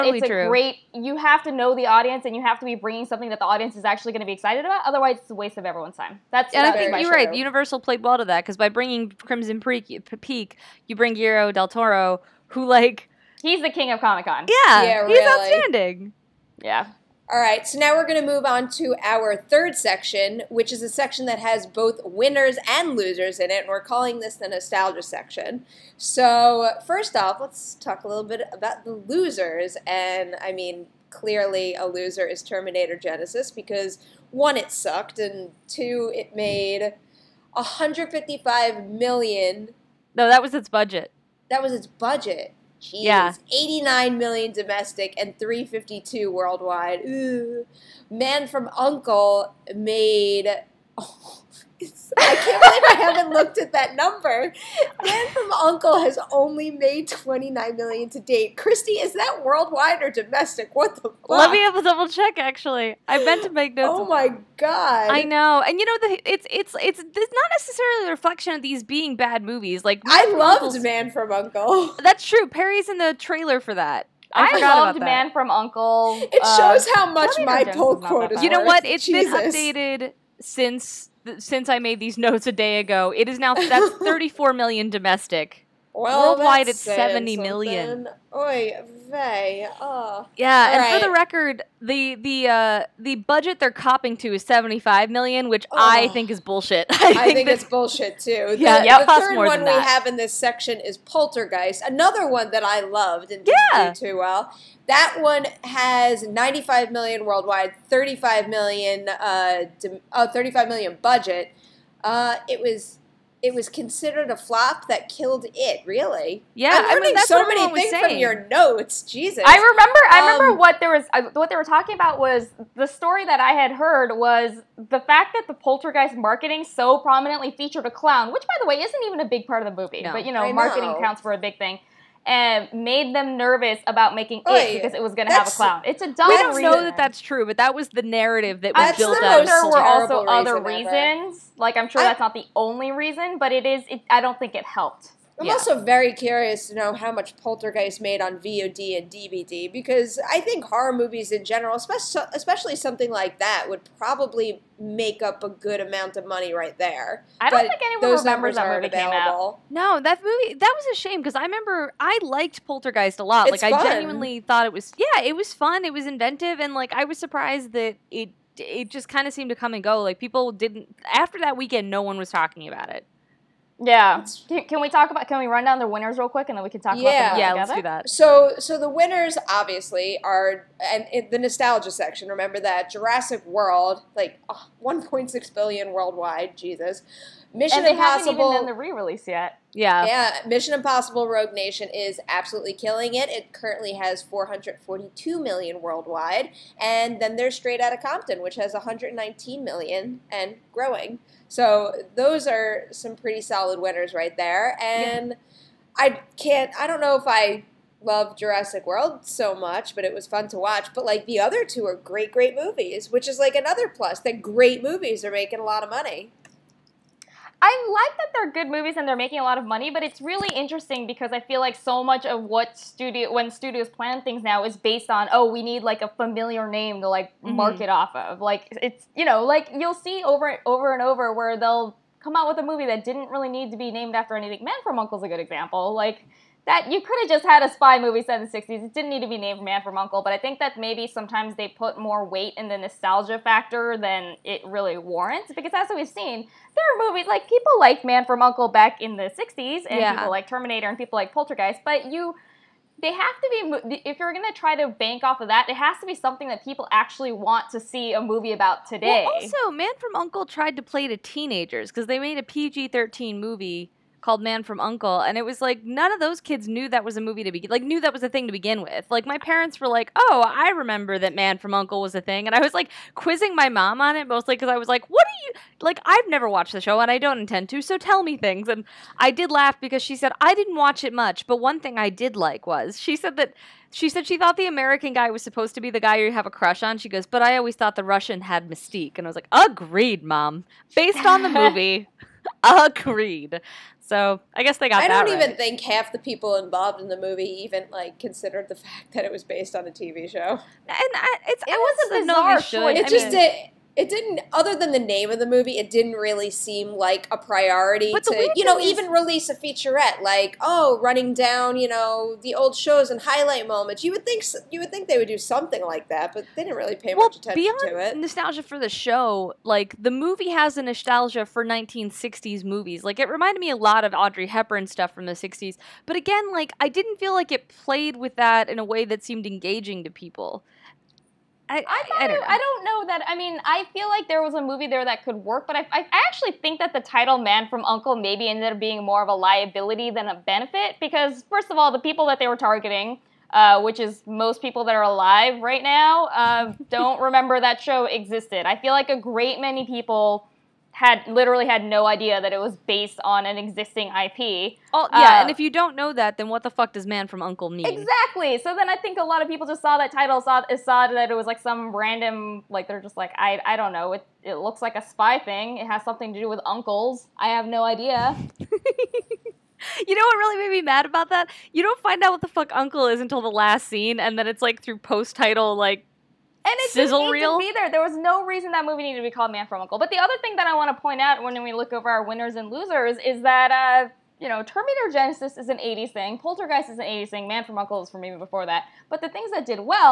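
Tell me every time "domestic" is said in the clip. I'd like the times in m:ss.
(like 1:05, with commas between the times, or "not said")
0:44, 1:00, 1:24.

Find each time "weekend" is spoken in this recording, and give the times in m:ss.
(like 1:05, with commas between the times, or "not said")
2:51.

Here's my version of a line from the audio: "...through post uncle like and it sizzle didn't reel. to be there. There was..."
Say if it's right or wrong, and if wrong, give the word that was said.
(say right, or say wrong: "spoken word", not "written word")
wrong: "title", not "uncle".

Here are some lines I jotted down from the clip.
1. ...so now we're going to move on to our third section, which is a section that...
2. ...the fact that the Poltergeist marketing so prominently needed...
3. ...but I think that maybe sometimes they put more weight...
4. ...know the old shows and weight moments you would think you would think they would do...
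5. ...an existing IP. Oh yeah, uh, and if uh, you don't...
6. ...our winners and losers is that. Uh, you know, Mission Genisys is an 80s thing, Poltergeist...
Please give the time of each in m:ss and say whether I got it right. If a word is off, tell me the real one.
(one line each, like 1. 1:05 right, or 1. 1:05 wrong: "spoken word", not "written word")
1. 0:17 right
2. 2:04 wrong: "featured", not "needed"
3. 4:00 right
4. 5:11 wrong: "highlight", not "weight"
5. 5:53 right
6. 6:22 wrong: "Terminator", not "Mission".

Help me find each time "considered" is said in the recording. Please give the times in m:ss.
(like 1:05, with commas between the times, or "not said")
1:53, 4:58.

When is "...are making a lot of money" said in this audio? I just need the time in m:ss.
3:35.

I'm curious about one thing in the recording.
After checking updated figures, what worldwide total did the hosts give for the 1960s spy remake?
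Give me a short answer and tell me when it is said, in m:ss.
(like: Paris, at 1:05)
70 million, at 1:26.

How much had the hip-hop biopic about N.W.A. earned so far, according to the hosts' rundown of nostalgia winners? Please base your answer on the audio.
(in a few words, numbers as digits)
119 million.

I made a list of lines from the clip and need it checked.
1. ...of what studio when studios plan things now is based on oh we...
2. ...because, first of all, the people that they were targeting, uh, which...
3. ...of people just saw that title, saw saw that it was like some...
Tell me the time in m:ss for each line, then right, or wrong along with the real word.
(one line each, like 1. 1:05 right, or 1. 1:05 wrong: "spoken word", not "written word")
1. 3:42 right
2. 5:41 right
3. 5:59 right.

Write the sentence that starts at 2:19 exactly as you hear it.
There were also reason other ever.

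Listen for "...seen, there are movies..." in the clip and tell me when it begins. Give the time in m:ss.
4:06.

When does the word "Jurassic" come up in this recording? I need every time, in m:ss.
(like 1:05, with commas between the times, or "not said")
3:02, 3:28.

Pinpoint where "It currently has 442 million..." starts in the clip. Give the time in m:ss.
3:13.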